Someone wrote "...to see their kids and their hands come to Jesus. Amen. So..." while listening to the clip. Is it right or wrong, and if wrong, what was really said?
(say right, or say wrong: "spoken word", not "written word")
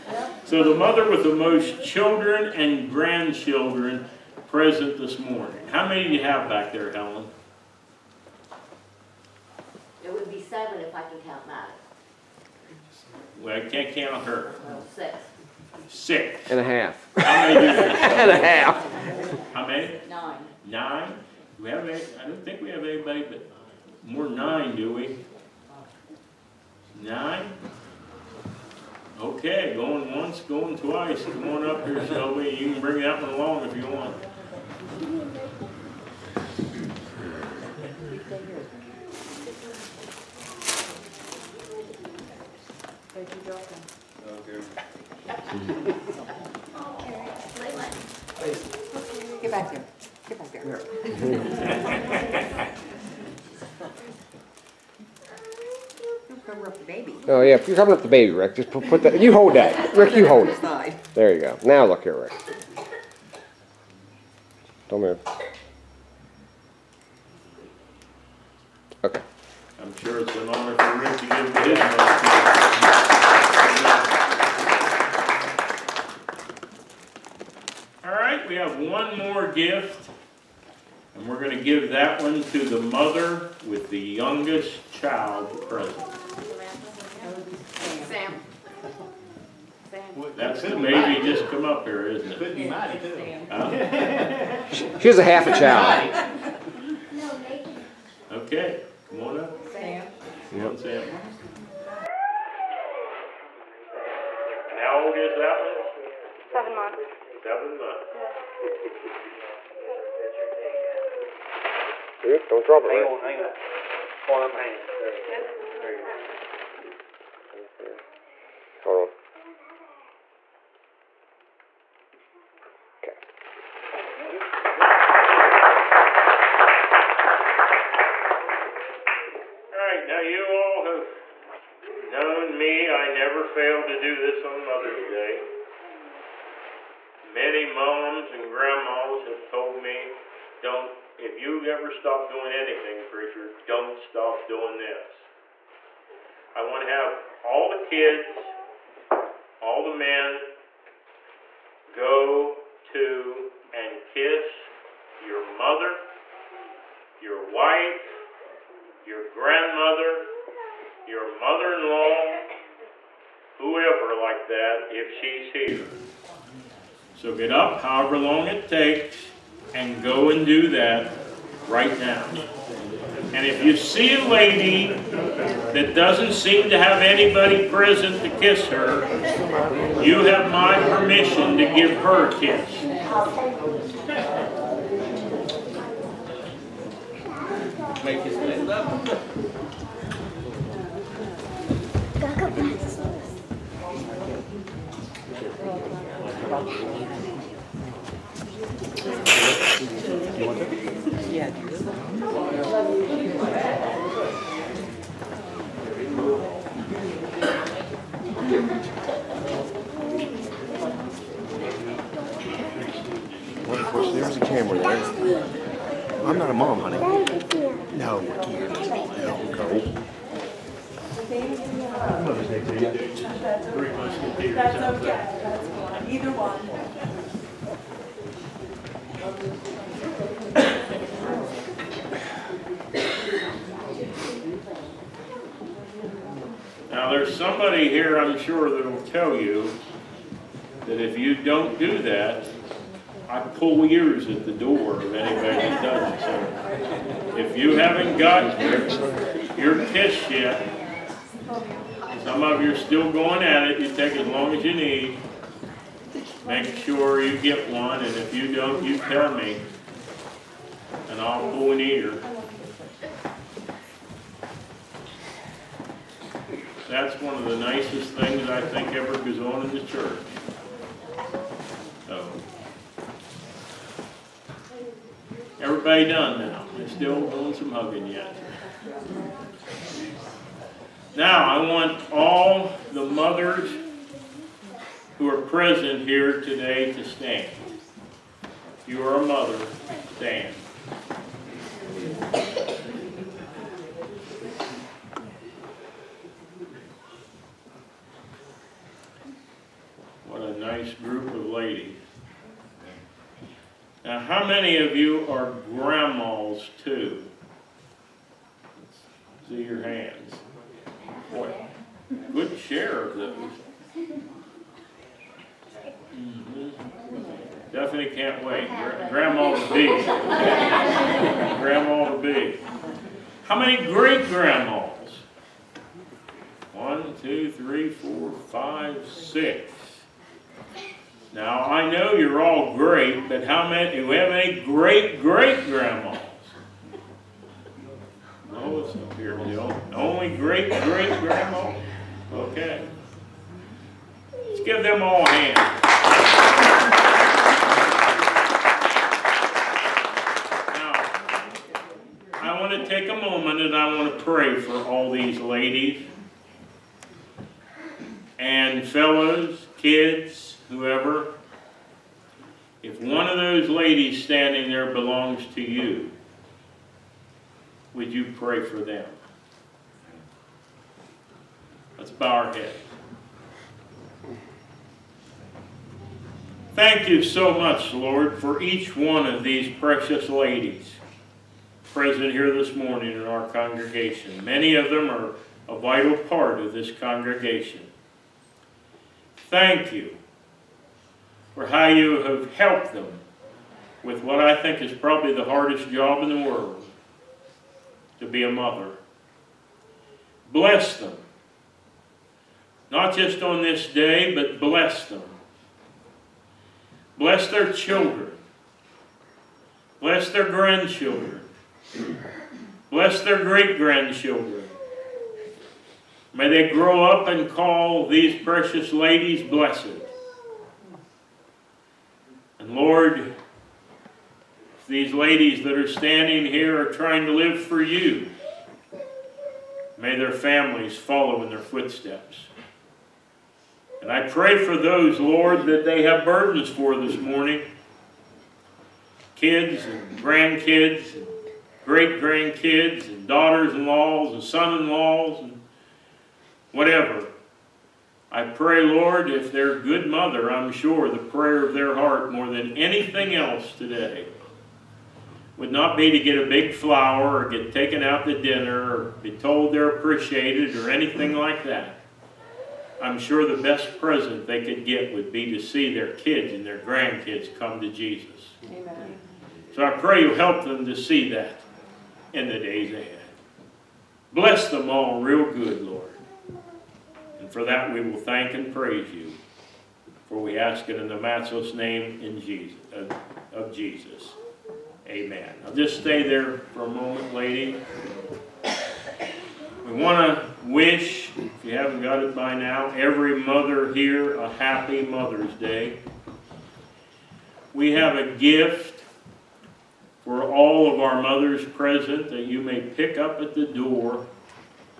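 wrong: "grandkids", not "hands".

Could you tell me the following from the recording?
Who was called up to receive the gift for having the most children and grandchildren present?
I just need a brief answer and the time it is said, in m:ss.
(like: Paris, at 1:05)
Shelby, at 0:32.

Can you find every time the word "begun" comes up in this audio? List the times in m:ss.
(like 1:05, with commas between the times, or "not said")
not said.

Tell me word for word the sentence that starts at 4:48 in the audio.
If you are a mother, stand.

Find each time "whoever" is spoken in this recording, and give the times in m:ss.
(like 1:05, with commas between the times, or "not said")
2:43, 6:00.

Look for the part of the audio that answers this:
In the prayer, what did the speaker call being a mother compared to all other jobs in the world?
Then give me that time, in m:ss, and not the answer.
6:35.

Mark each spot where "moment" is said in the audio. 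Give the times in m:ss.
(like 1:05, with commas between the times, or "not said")
5:53, 8:06.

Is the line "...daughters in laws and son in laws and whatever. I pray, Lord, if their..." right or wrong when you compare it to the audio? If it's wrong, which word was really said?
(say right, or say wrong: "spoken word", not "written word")
right.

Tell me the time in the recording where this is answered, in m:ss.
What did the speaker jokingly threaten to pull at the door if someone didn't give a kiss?
4:03.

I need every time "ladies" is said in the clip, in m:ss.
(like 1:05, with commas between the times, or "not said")
5:55, 6:03, 6:20, 6:58, 7:05.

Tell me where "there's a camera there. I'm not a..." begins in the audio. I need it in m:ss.
3:34.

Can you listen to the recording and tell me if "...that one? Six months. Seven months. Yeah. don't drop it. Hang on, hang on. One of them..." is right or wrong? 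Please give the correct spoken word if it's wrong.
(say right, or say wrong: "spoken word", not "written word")
wrong: "Seven", not "Six".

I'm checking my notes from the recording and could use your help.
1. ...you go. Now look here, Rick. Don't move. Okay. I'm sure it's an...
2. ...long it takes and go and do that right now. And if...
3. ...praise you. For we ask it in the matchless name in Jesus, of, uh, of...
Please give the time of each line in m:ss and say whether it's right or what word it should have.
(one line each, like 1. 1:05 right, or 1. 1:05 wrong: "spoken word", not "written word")
1. 1:01 right
2. 2:48 right
3. 7:58 right.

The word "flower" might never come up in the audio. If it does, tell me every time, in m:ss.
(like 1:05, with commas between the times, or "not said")
7:36.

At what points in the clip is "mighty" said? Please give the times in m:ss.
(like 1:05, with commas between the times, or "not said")
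1:32.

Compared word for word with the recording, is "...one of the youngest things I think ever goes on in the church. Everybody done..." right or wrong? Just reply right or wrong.
wrong.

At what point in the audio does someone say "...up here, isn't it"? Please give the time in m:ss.
1:31.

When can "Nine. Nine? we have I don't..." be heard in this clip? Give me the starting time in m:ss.
0:20.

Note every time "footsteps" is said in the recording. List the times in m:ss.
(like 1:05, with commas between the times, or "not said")
7:11.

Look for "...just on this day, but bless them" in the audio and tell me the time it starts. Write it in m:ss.
6:43.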